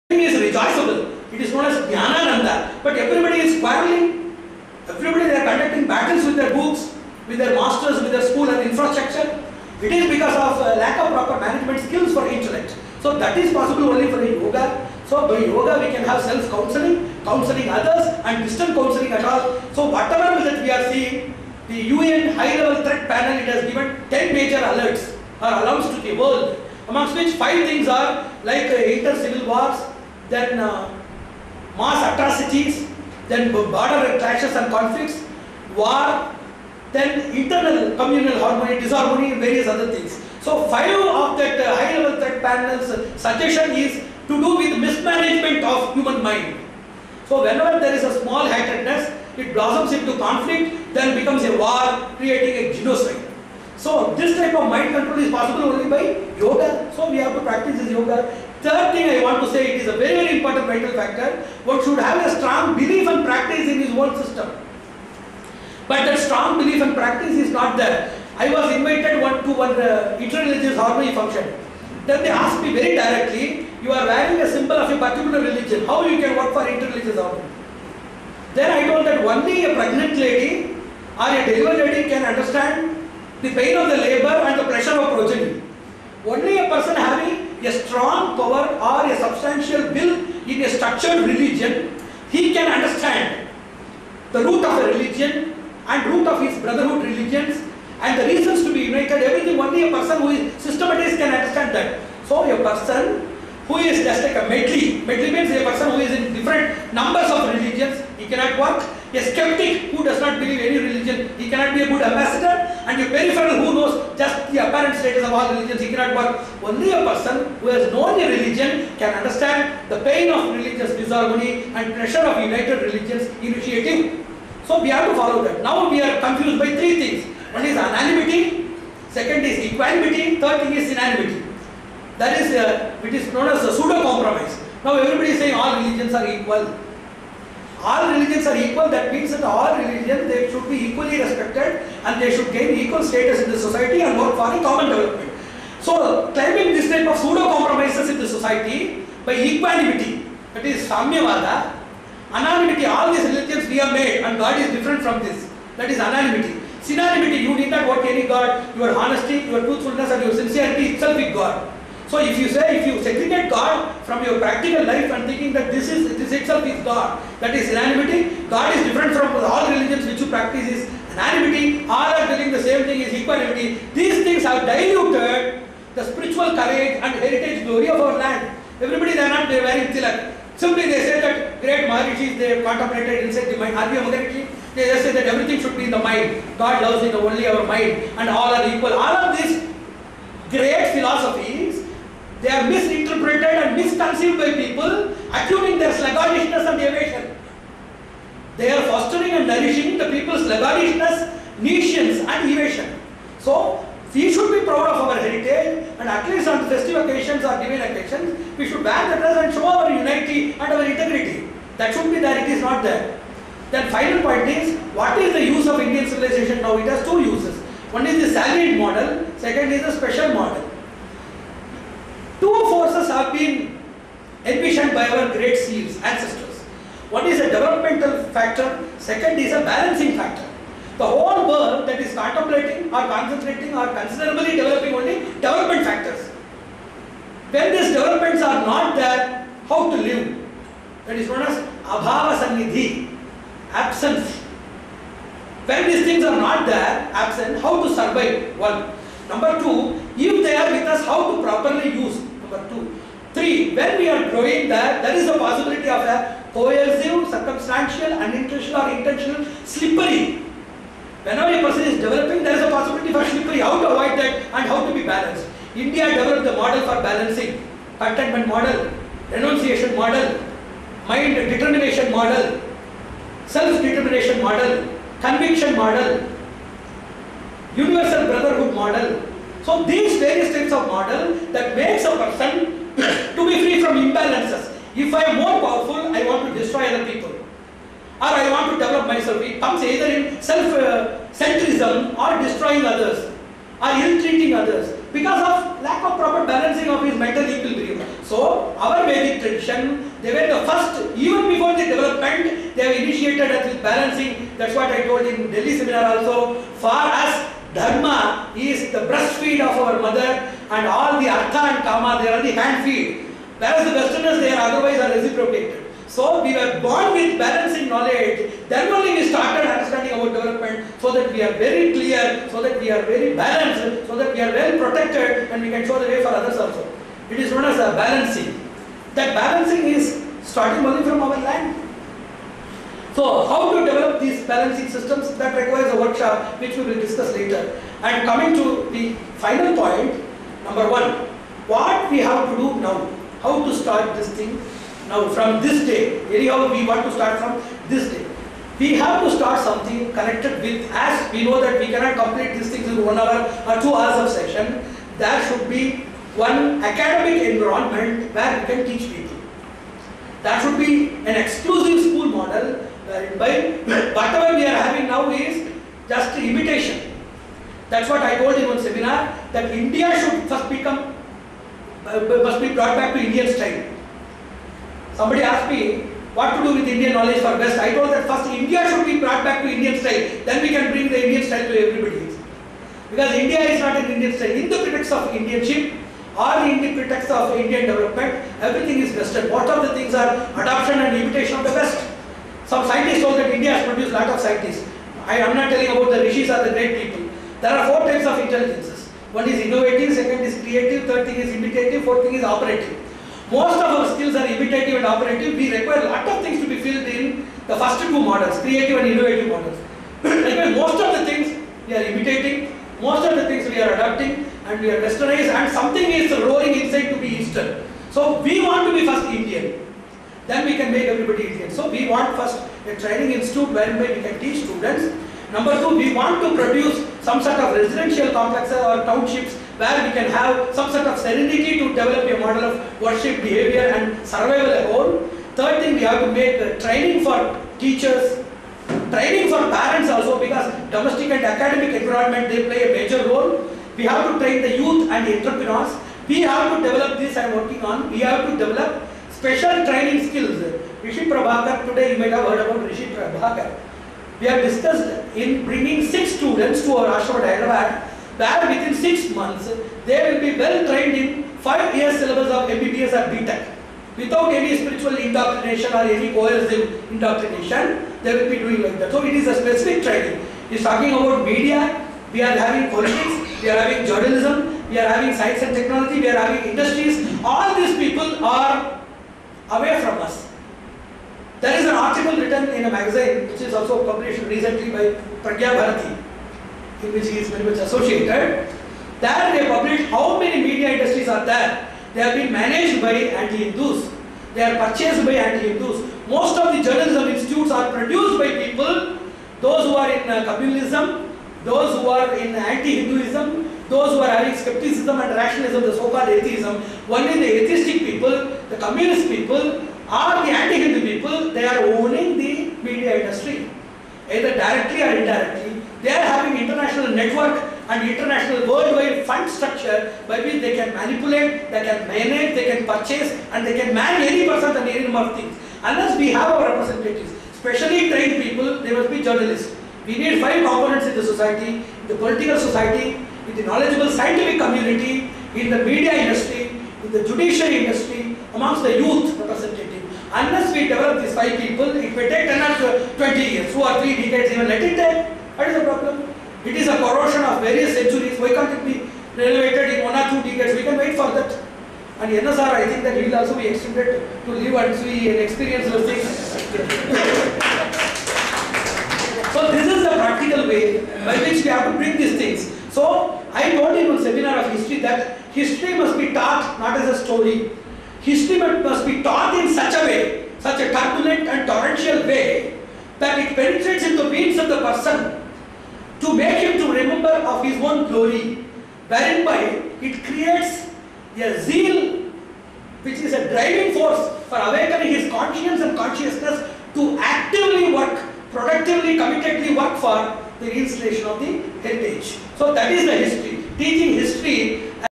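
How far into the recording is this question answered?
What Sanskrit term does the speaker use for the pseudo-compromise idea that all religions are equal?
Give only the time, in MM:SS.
02:30.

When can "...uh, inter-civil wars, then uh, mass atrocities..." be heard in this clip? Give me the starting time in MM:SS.
00:28.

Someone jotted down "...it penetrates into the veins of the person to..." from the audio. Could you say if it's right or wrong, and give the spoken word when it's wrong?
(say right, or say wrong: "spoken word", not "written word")
right.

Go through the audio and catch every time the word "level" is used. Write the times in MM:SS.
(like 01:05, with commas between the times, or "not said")
00:22, 00:41.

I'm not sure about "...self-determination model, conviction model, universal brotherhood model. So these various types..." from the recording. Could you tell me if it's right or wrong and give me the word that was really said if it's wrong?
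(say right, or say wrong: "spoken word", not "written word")
right.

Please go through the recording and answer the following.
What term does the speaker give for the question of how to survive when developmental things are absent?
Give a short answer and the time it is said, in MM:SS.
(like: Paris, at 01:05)
abhava sannidhi, at 04:01.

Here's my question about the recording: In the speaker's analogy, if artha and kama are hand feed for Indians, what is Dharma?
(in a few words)
breastfeed of our mother.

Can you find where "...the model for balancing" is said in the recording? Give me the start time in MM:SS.
04:26.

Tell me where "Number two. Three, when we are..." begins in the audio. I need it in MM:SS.
04:12.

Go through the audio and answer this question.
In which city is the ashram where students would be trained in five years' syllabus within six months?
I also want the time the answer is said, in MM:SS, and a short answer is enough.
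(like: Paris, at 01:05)
Hyderabad, at 07:37.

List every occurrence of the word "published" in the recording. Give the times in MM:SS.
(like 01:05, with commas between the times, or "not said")
08:04, 08:09.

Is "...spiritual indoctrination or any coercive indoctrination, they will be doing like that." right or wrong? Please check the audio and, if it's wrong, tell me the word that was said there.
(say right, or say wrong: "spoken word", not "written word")
right.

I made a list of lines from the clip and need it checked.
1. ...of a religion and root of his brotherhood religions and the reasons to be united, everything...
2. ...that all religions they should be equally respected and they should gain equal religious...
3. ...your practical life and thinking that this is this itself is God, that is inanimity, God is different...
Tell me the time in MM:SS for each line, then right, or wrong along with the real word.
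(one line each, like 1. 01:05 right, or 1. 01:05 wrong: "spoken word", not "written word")
1. 01:34 right
2. 02:19 wrong: "status", not "religious"
3. 02:44 right.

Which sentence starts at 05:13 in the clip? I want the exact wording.
Whereas the Westerners, they are otherwise are reciprocated.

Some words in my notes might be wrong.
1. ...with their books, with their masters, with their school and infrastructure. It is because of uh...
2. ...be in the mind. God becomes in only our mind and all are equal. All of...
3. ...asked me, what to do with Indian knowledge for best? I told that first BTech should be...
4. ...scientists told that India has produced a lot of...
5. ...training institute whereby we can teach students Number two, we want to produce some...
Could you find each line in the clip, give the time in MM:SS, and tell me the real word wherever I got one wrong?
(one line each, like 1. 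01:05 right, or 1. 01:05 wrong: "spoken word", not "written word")
1. 00:06 right
2. 03:05 wrong: "loves", not "becomes"
3. 06:15 wrong: "India", not "BTech"
4. 06:32 right
5. 07:02 right.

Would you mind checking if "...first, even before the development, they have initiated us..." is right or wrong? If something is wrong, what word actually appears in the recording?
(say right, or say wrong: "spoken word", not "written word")
right.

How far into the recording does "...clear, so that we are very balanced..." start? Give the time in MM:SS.
05:21.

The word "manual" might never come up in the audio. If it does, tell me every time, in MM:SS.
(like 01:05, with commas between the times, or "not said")
not said.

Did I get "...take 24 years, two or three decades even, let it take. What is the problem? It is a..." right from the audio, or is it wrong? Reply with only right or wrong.
wrong.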